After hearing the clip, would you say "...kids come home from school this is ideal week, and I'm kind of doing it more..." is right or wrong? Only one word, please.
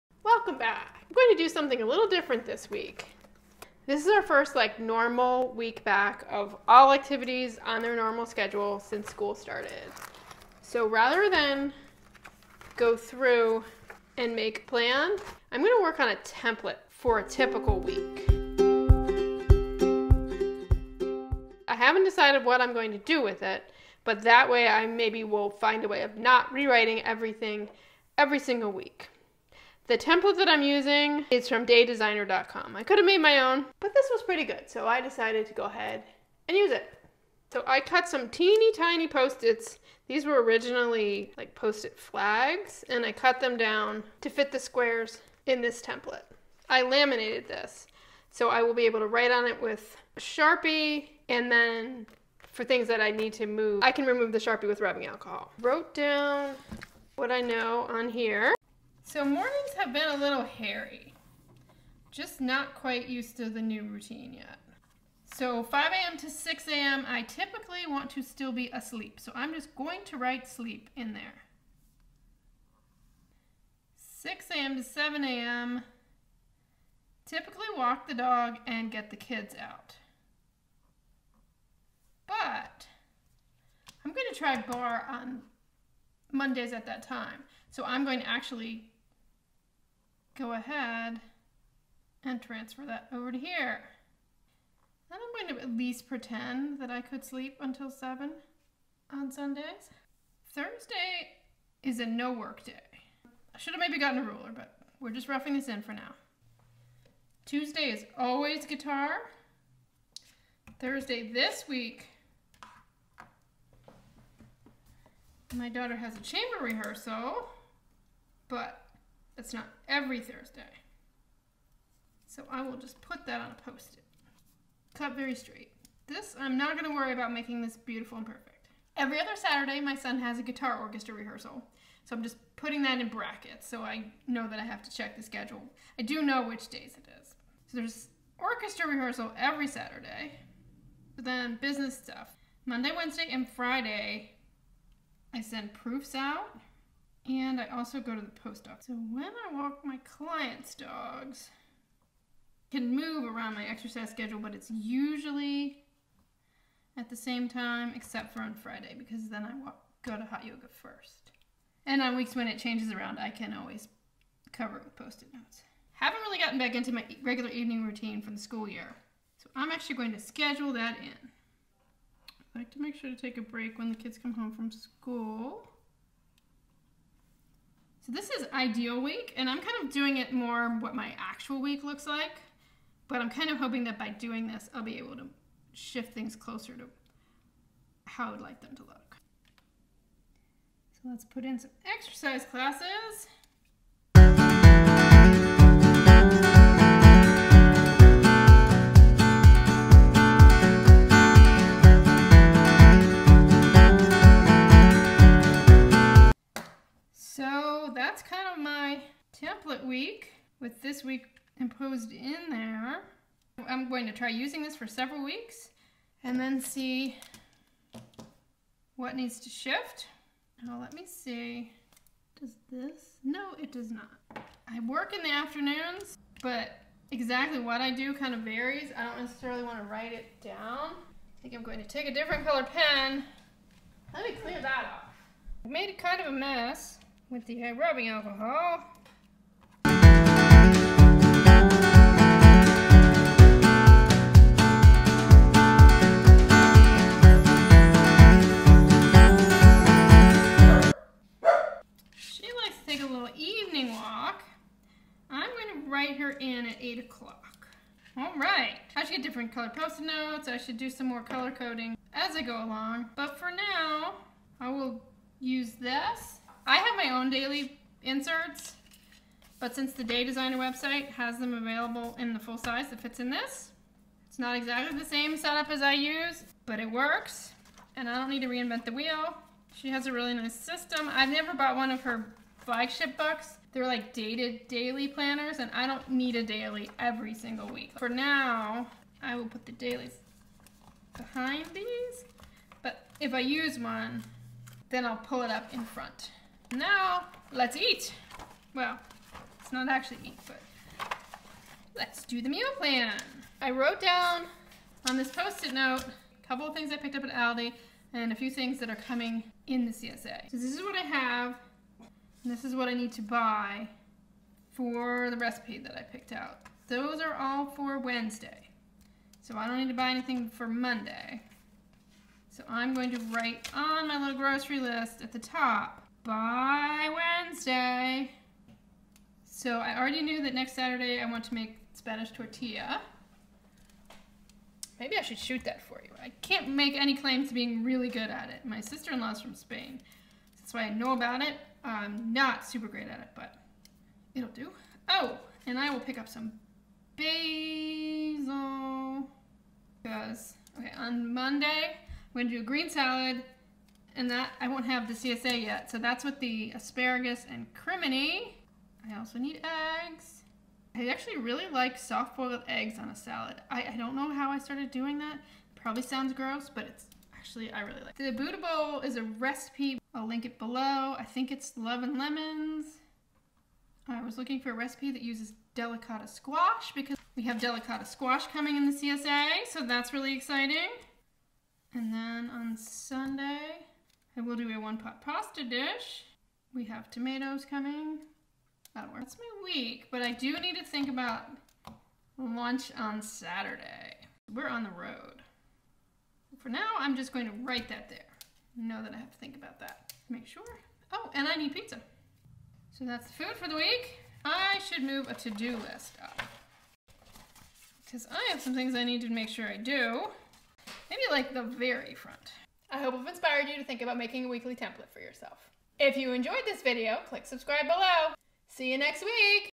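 right.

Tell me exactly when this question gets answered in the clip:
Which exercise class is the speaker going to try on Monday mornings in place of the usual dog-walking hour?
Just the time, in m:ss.
1:24.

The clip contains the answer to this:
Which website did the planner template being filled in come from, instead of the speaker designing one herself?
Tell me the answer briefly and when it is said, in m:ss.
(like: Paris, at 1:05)
daydesigner.com, at 0:31.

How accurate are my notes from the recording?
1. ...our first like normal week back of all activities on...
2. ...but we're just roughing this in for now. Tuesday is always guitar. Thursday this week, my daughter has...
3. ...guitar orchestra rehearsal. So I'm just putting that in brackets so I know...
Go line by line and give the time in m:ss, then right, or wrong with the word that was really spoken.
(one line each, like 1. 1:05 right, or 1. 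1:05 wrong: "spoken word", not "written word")
1. 0:04 right
2. 1:44 right
3. 2:10 right.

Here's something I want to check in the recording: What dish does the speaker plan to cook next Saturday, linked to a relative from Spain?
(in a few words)
Spanish tortilla.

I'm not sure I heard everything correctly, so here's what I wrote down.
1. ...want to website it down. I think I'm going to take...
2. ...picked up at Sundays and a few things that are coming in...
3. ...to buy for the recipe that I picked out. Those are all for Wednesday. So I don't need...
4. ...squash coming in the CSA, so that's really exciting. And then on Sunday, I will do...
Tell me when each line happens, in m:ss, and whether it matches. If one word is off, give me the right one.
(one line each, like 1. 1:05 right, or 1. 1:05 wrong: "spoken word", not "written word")
1. 3:49 wrong: "write", not "website"
2. 5:06 wrong: "Aldi", not "Sundays"
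3. 5:13 right
4. 6:18 right.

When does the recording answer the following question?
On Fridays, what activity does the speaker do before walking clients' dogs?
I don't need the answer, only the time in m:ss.
2:40.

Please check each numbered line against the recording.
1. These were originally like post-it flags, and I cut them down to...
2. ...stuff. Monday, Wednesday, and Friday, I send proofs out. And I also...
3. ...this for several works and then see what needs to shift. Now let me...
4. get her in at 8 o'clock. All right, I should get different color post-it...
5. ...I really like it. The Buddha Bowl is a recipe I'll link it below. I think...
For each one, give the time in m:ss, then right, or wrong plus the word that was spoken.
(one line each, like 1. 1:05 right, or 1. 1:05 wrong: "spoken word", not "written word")
1. 0:40 right
2. 2:21 right
3. 3:34 wrong: "weeks", not "works"
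4. 4:16 right
5. 6:07 right.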